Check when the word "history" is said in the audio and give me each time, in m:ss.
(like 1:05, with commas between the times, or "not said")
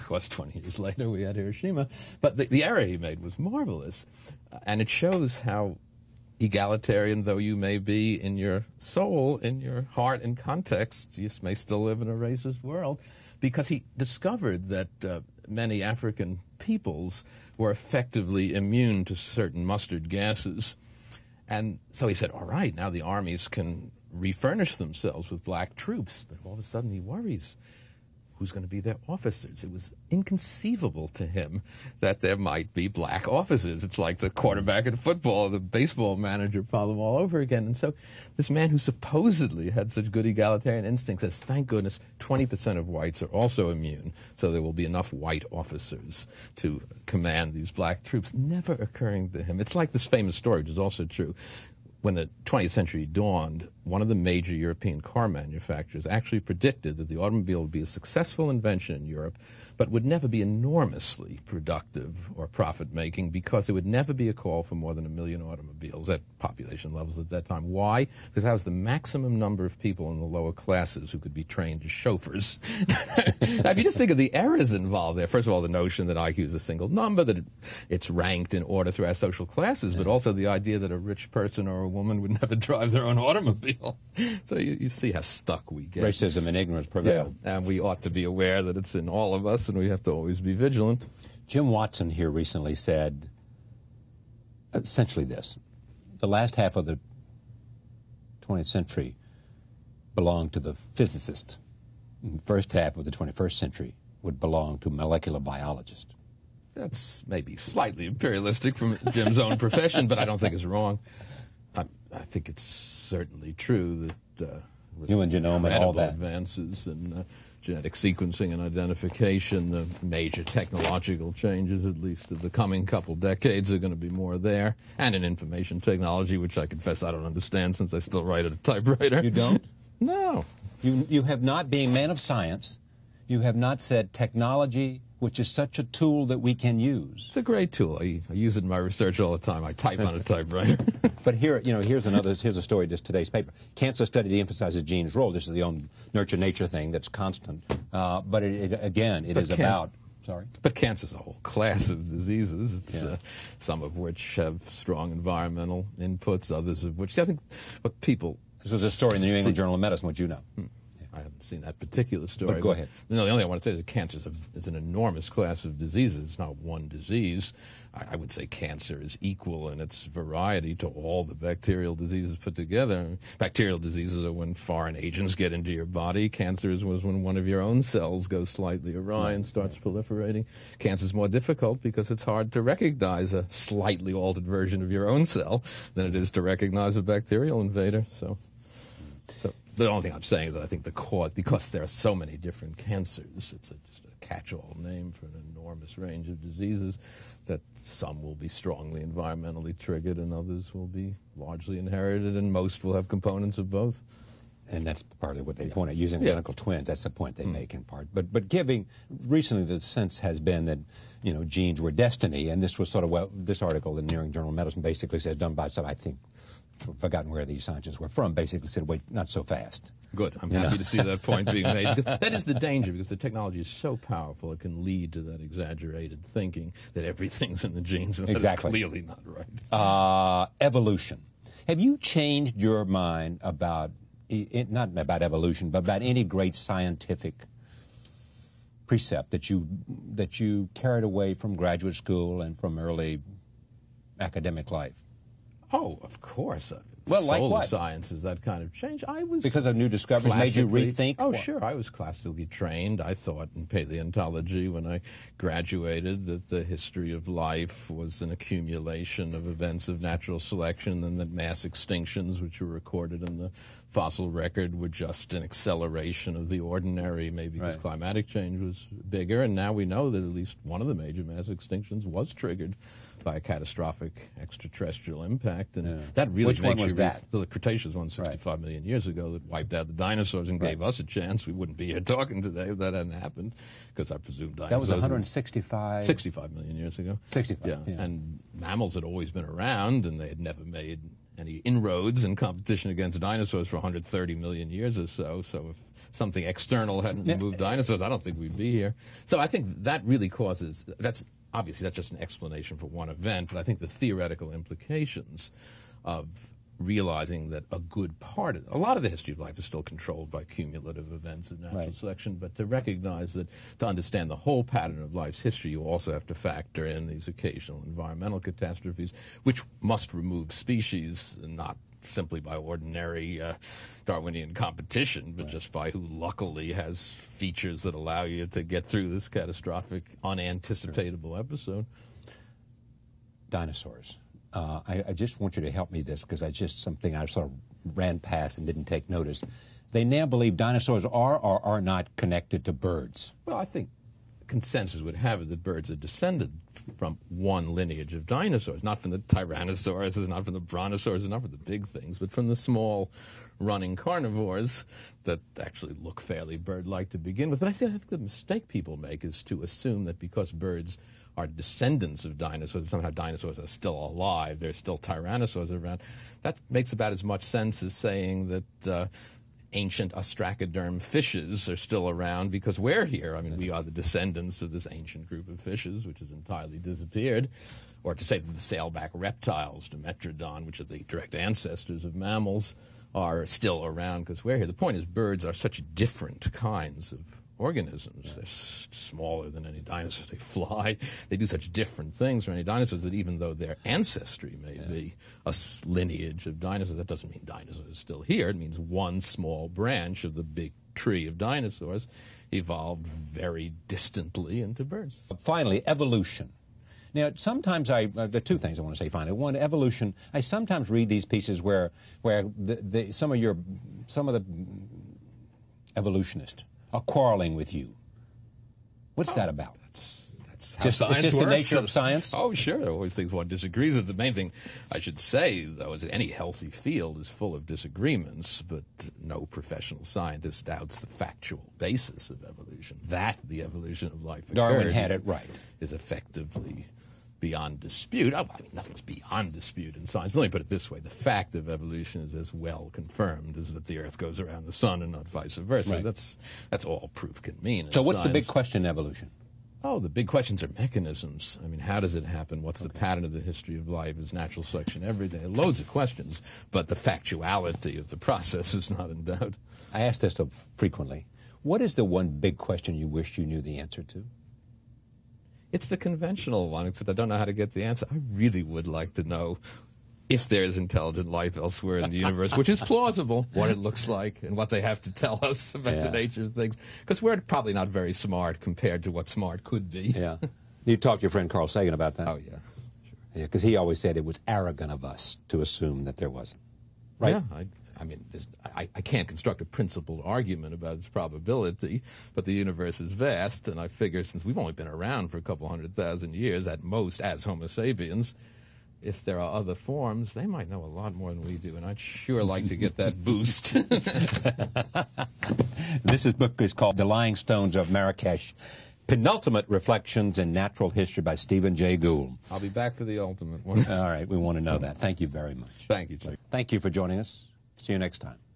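4:16, 5:09, 5:15, 7:33, 8:30.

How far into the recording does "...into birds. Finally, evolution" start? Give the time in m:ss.
6:44.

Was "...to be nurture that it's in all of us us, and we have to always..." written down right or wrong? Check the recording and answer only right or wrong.
wrong.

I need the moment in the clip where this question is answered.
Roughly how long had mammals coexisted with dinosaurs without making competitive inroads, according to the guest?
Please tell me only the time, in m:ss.
4:53.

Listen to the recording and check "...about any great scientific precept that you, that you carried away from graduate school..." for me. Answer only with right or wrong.
right.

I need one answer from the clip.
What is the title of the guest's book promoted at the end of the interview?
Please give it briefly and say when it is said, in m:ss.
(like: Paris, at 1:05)
The Lying Stones of Marrakesh, at 8:26.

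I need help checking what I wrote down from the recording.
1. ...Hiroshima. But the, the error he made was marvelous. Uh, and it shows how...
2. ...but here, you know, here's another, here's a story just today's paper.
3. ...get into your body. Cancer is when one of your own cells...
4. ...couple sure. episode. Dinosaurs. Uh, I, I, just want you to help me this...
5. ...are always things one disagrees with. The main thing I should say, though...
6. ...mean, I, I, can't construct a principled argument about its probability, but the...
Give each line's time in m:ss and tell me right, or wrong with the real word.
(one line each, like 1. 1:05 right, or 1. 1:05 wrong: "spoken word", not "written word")
1. 0:01 right
2. 2:21 right
3. 2:55 right
4. 5:30 wrong: "unanticipatable", not "couple"
5. 7:02 right
6. 8:08 right.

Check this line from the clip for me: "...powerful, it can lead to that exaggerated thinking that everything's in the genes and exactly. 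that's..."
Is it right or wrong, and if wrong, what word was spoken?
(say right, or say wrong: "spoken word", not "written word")
right.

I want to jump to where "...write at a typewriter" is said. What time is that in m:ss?
2:08.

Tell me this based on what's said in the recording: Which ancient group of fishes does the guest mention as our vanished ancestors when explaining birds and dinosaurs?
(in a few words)
ostracoderm fishes.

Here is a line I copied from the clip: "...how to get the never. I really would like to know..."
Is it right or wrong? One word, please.
wrong.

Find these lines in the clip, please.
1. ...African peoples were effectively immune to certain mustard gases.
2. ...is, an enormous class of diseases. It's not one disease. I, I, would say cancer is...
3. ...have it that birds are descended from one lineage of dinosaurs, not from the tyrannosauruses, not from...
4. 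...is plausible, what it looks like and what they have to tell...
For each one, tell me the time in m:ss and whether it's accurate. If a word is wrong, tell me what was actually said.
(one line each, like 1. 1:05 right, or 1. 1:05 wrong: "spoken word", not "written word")
1. 0:15 right
2. 2:44 right
3. 5:45 right
4. 7:52 right.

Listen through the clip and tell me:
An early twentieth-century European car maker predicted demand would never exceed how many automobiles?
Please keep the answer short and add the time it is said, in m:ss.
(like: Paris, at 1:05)
1 million, at 1:05.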